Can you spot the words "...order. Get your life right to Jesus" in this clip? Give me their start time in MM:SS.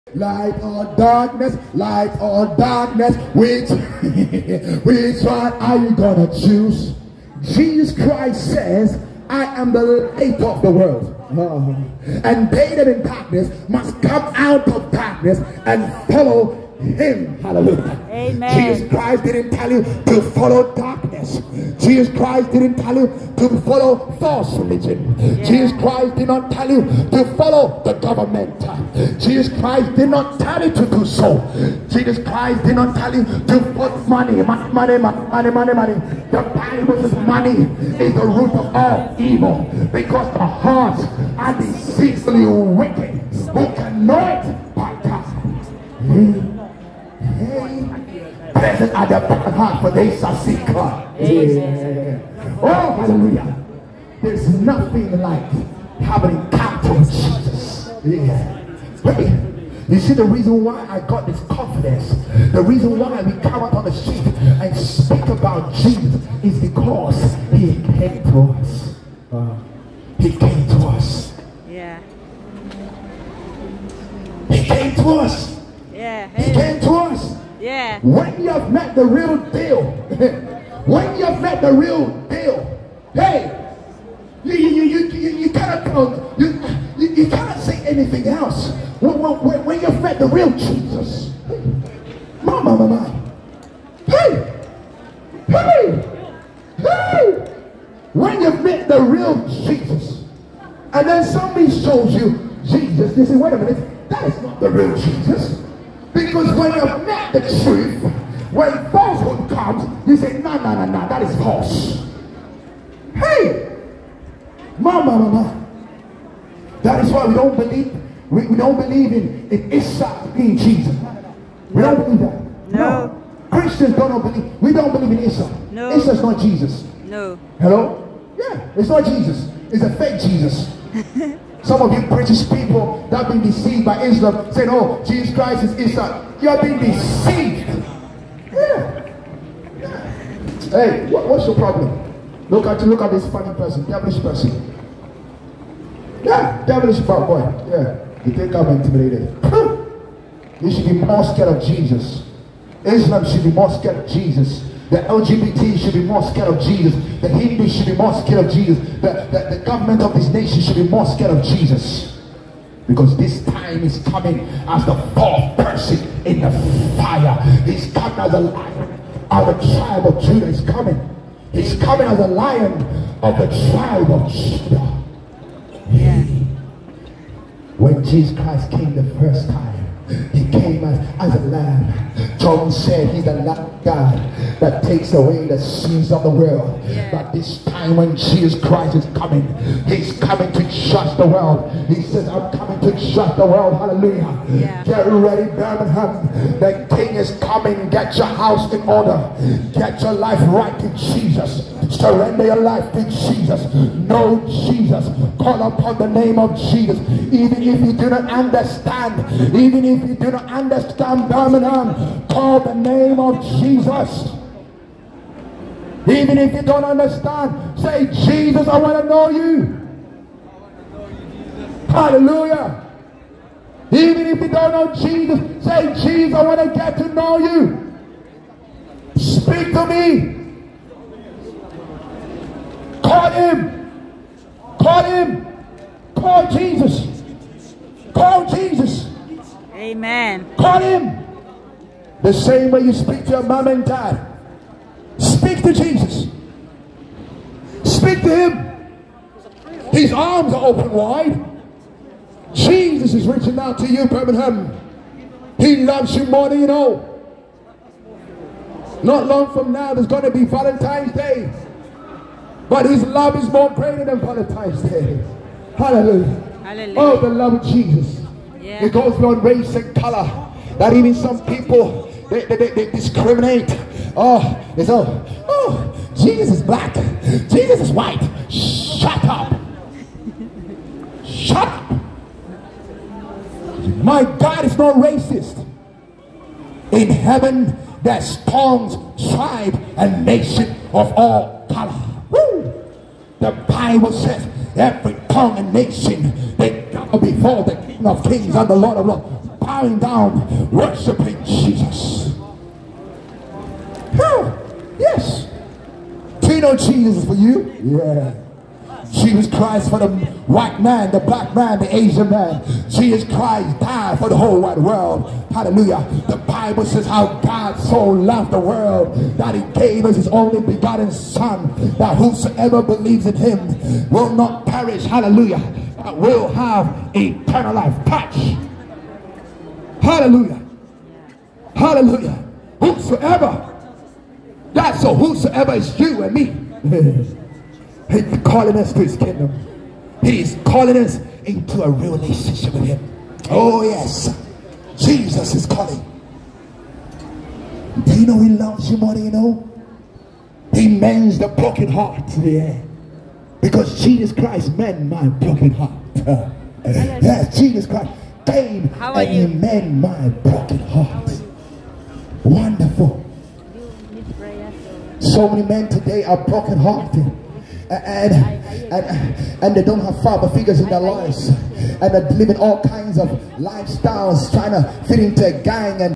03:18.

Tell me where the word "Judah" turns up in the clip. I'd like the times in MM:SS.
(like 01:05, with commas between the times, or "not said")
02:50, 02:54.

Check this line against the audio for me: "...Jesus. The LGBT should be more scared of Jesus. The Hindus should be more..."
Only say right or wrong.
right.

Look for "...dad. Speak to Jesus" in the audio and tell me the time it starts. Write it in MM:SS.
04:03.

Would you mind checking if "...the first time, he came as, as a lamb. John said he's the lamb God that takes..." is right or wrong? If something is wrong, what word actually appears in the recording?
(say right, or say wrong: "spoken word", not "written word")
right.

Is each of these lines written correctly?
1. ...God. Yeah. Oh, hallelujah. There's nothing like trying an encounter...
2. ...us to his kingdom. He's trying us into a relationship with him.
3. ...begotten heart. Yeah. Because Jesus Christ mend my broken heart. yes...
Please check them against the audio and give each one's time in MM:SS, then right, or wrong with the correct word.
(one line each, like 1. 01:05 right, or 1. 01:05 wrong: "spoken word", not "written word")
1. 00:50 wrong: "having", not "trying"
2. 05:38 wrong: "calling", not "trying"
3. 05:51 wrong: "broken", not "begotten".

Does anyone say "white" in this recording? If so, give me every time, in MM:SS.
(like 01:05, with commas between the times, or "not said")
04:37, 05:10.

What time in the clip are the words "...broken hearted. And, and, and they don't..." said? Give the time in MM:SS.
06:06.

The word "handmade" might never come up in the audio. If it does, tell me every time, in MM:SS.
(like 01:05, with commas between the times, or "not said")
not said.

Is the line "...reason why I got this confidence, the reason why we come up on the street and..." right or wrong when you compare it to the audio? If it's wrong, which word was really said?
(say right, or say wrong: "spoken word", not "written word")
right.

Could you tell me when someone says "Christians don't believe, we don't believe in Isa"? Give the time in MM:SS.
02:03.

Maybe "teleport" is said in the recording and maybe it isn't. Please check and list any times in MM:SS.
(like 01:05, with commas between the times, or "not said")
not said.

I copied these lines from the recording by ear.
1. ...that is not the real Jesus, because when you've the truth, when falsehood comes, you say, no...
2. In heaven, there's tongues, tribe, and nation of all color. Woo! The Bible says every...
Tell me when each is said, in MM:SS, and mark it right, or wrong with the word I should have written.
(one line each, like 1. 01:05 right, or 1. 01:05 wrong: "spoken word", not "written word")
1. 01:44 right
2. 04:46 right.